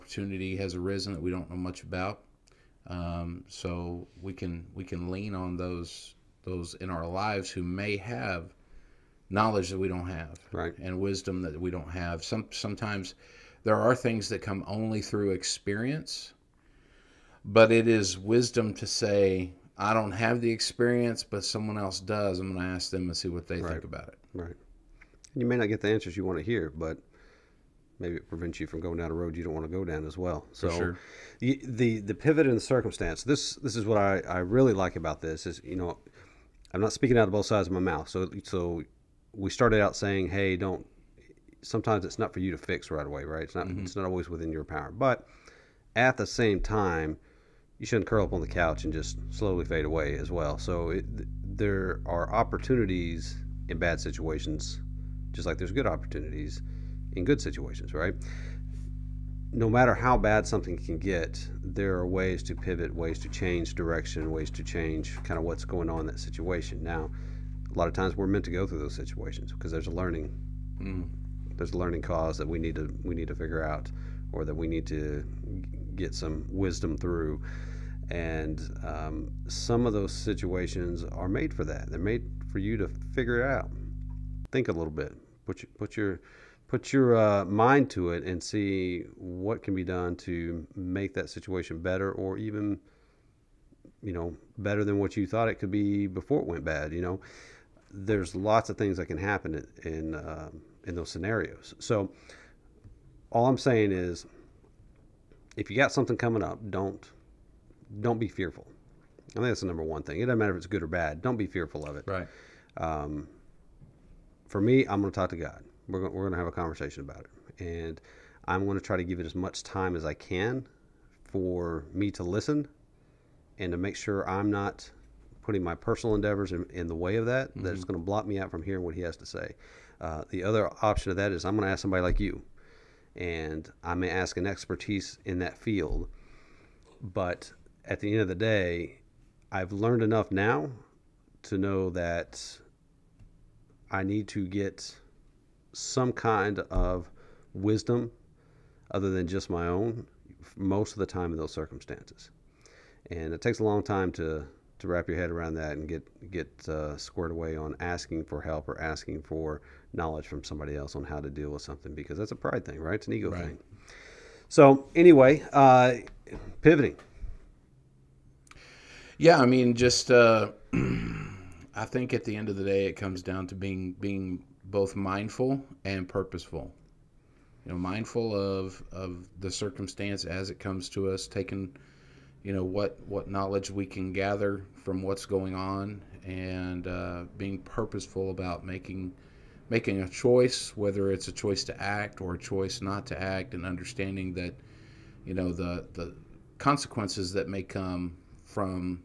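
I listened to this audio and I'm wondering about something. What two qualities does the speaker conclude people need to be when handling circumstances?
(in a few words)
Mindful and purposeful.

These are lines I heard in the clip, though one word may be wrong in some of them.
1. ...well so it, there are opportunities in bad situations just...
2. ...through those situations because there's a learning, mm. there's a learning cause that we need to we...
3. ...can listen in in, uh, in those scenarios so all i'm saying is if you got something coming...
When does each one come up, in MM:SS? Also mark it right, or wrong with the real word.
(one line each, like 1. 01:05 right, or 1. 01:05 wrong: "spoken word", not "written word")
1. 00:50 right
2. 01:08 right
3. 01:39 wrong: "happen", not "listen".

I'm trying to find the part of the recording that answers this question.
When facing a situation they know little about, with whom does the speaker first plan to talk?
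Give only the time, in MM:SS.
01:55.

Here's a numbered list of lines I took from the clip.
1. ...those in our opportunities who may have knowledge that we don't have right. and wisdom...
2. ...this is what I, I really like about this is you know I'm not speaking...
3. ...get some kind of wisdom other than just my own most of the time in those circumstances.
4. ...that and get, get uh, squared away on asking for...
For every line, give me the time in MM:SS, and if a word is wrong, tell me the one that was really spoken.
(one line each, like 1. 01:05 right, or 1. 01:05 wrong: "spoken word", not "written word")
1. 00:06 wrong: "lives", not "opportunities"
2. 00:33 right
3. 02:24 right
4. 02:35 right.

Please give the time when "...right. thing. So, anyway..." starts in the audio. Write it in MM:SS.
02:43.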